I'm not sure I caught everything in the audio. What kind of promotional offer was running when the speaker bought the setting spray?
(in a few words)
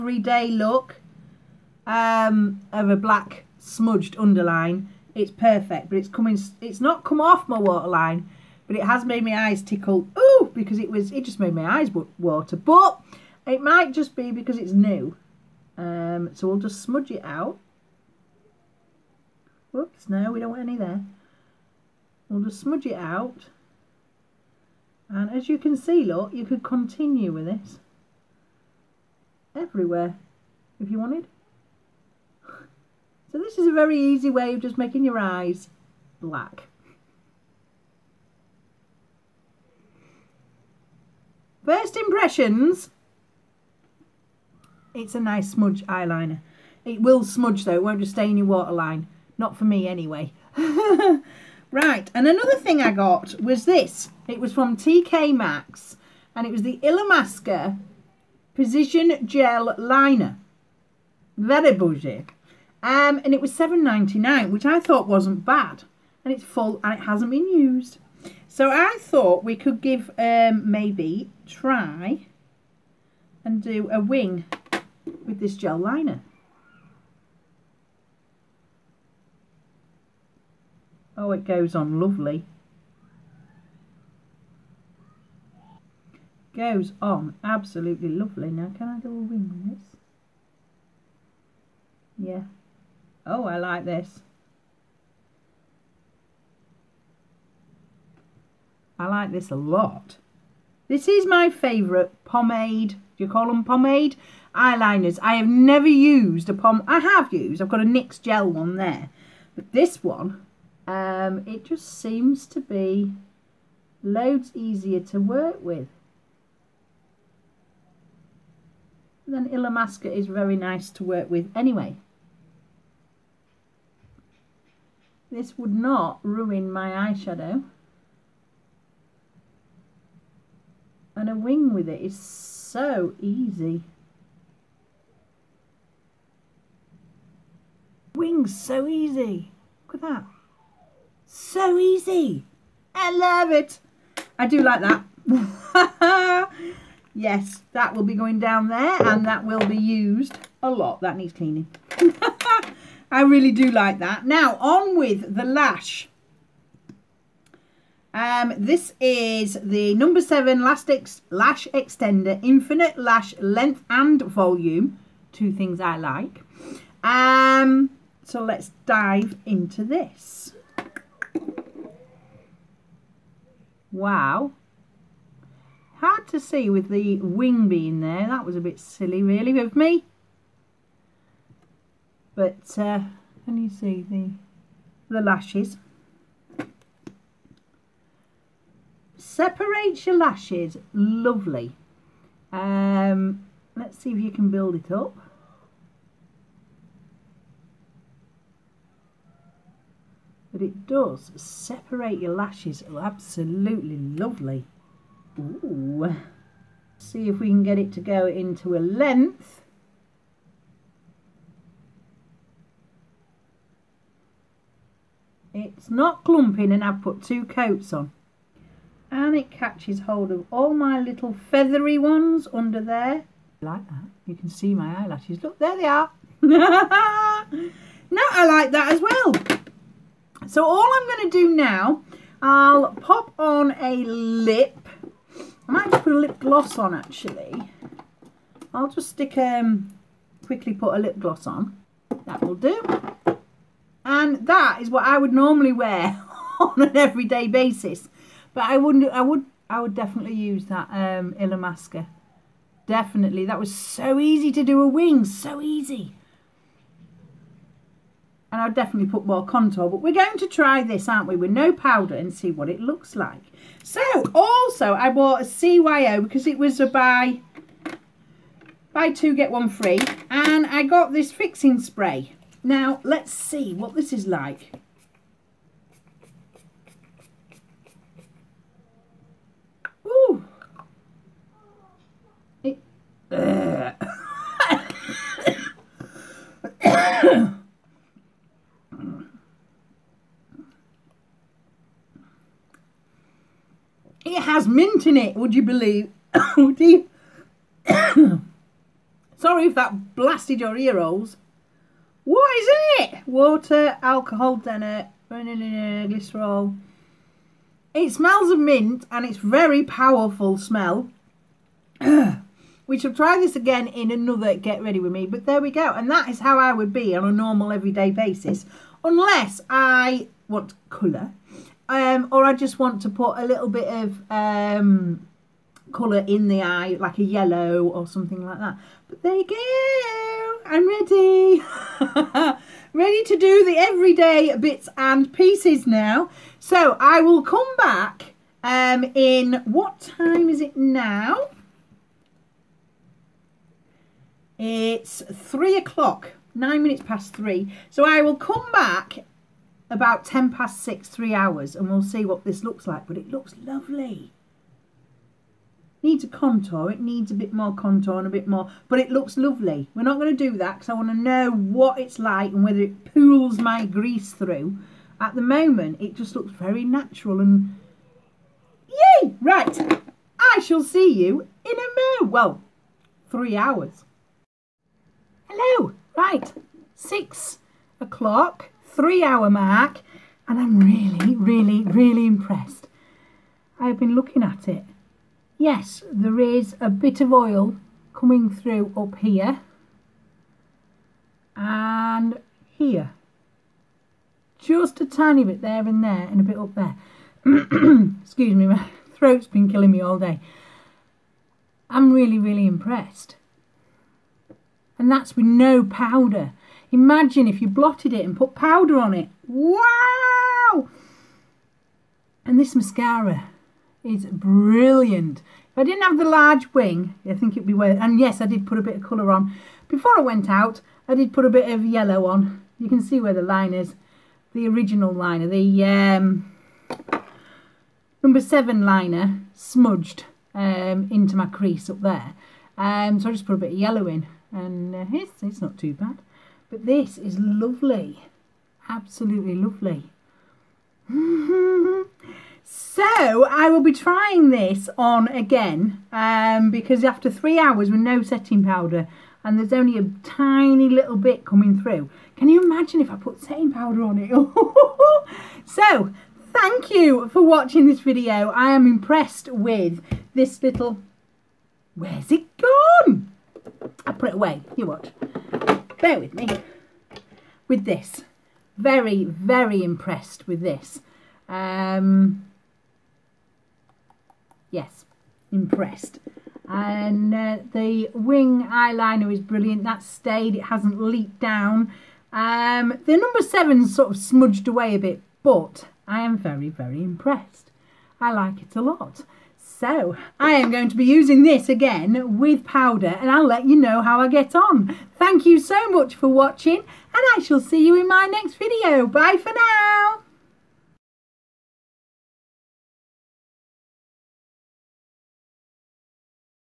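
Buy two, get one free.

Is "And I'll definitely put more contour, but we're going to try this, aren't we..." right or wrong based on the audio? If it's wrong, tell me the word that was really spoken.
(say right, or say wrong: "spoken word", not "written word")
right.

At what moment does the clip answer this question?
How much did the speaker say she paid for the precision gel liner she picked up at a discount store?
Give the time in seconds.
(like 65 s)
63 s.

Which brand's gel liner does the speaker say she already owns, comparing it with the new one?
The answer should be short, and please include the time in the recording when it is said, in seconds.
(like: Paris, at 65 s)
NYX, at 107 s.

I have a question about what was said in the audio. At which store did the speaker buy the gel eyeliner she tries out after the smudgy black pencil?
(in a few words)
TK Maxx.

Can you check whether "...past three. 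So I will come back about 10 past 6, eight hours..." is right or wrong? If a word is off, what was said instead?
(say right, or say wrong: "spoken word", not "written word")
wrong: "three", not "eight".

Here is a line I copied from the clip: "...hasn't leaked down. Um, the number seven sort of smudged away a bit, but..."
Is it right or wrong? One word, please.
right.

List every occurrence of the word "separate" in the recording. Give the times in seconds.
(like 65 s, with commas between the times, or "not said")
201 s.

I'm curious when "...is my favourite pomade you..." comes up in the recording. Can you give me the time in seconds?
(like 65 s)
101 s.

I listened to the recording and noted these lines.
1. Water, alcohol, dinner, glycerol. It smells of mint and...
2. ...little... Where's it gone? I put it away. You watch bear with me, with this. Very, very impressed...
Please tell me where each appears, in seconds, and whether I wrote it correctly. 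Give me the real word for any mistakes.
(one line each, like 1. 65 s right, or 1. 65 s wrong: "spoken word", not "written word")
1. 303 s right
2. 460 s right.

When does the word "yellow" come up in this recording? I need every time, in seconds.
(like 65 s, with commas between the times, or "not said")
327 s, 421 s, 433 s.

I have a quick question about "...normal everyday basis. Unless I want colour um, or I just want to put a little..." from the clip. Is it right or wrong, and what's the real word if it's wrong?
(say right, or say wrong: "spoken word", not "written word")
right.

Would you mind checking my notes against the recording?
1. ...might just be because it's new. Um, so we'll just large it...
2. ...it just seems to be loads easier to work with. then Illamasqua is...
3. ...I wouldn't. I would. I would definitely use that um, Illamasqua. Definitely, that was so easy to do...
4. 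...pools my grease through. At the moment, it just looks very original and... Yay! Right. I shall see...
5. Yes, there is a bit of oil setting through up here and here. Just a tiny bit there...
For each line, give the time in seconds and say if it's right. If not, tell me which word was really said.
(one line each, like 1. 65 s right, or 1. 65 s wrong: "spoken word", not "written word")
1. 13 s wrong: "smudge", not "large"
2. 111 s right
3. 248 s right
4. 363 s wrong: "natural", not "original"
5. 385 s wrong: "coming", not "setting".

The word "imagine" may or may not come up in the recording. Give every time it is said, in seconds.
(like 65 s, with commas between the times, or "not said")
406 s, 452 s.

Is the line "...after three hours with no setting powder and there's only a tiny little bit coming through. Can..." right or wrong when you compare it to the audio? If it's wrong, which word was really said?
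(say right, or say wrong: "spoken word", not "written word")
right.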